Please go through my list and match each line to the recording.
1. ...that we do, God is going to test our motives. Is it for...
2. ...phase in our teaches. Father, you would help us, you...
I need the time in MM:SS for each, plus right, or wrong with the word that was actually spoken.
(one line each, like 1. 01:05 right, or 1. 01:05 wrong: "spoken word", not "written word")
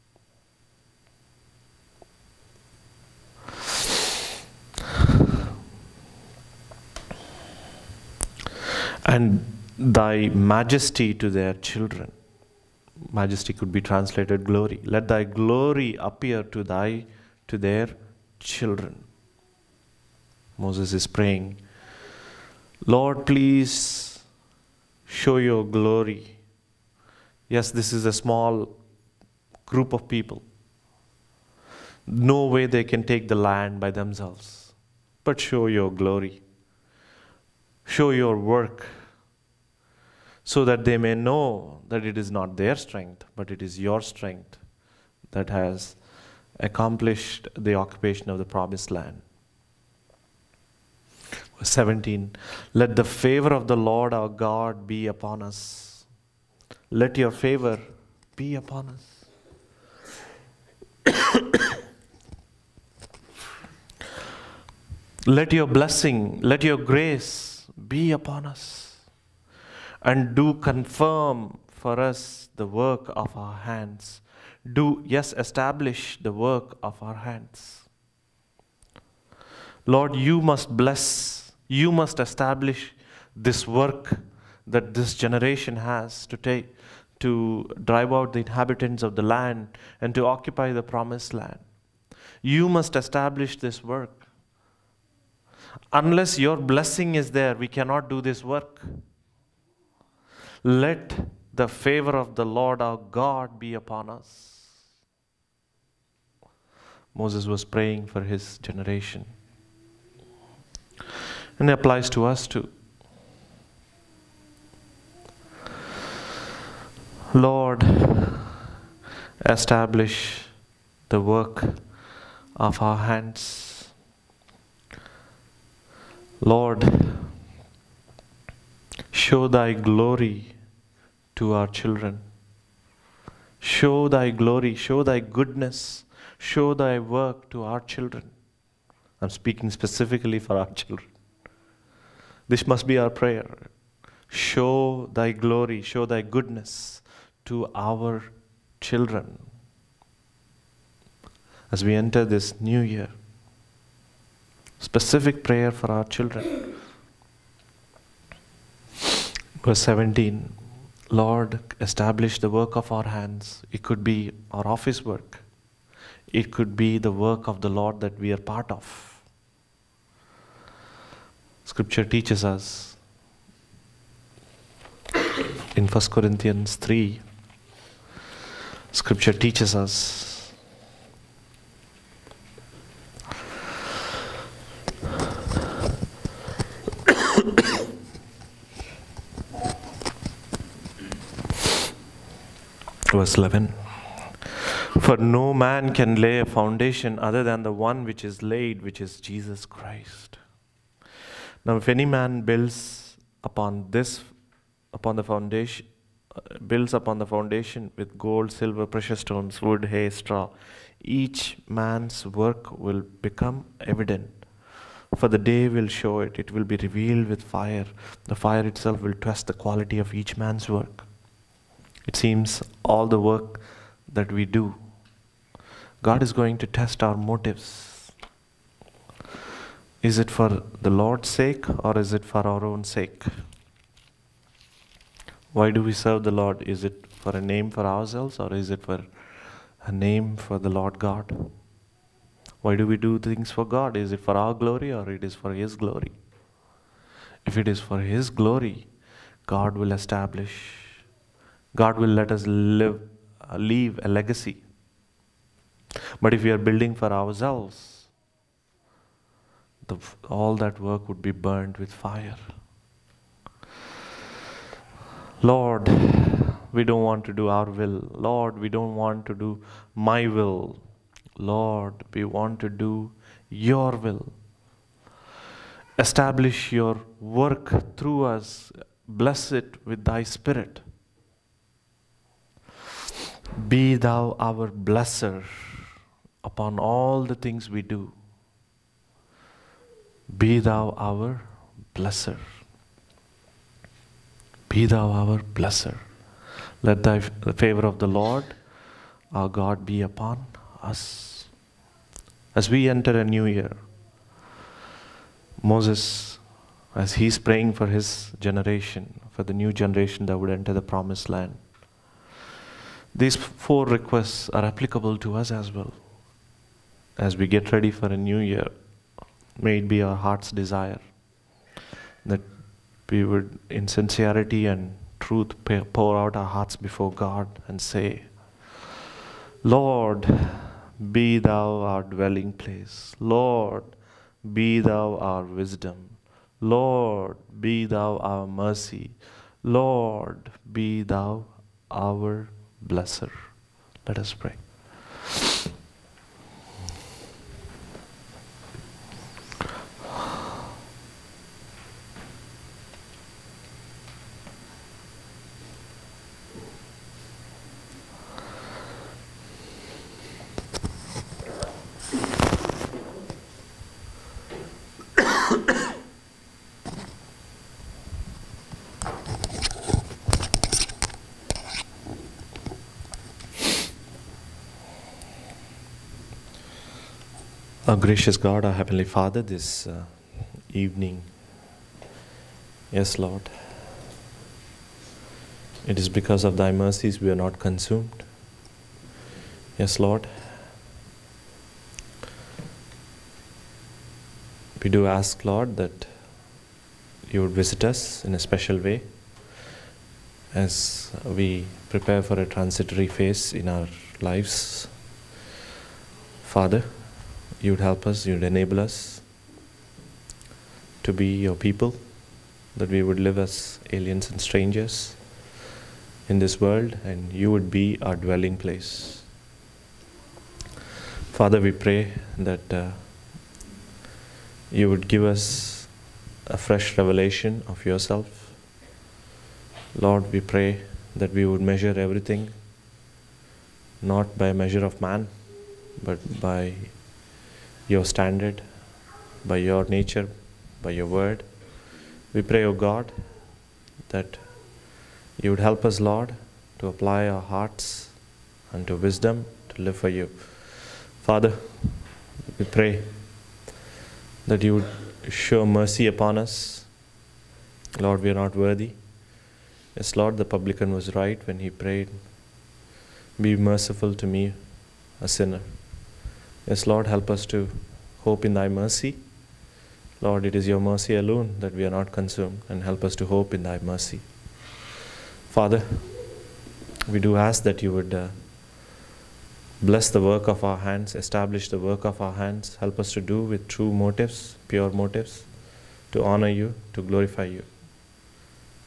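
1. 03:44 right
2. 06:43 wrong: "lives", not "teaches".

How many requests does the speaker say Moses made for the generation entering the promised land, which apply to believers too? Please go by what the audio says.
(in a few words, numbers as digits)
4.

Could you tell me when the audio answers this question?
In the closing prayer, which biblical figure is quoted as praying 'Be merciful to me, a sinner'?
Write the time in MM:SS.
07:40.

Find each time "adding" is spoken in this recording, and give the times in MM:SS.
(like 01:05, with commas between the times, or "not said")
not said.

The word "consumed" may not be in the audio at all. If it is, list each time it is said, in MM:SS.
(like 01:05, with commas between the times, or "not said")
06:27, 07:52.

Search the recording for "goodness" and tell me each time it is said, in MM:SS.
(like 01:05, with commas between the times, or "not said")
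02:15, 02:26.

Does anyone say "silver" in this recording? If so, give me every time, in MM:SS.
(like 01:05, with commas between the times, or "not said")
03:28.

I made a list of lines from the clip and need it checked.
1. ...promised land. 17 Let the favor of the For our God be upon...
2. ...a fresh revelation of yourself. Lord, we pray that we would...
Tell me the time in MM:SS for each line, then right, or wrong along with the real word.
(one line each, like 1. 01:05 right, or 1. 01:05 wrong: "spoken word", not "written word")
1. 00:48 wrong: "Lord", not "For"
2. 07:06 right.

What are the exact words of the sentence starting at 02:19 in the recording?
I'm speaking specifically for our children.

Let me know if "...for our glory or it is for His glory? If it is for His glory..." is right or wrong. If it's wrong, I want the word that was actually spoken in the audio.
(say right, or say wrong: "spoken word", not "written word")
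right.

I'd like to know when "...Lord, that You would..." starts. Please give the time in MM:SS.
06:35.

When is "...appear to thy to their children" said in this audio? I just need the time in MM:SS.
00:15.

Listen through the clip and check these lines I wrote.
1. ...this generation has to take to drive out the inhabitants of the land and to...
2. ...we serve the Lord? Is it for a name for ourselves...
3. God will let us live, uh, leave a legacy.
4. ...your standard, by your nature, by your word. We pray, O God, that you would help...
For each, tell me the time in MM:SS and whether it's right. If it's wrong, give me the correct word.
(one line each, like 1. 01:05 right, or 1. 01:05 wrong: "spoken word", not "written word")
1. 01:24 right
2. 03:55 right
3. 04:11 right
4. 07:17 right.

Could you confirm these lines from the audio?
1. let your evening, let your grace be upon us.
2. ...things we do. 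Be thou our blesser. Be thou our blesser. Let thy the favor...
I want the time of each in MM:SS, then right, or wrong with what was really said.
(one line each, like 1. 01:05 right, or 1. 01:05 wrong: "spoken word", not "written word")
1. 01:05 wrong: "blessing", not "evening"
2. 04:47 right.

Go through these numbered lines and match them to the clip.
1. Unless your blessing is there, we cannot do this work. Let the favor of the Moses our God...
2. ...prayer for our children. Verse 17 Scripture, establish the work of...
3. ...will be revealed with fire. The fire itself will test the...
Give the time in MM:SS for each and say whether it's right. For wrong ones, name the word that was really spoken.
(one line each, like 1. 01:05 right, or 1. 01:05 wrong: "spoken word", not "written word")
1. 01:35 wrong: "Lord", not "Moses"
2. 02:35 wrong: "Lord", not "Scripture"
3. 03:36 right.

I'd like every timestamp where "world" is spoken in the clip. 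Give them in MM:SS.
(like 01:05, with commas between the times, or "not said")
06:56.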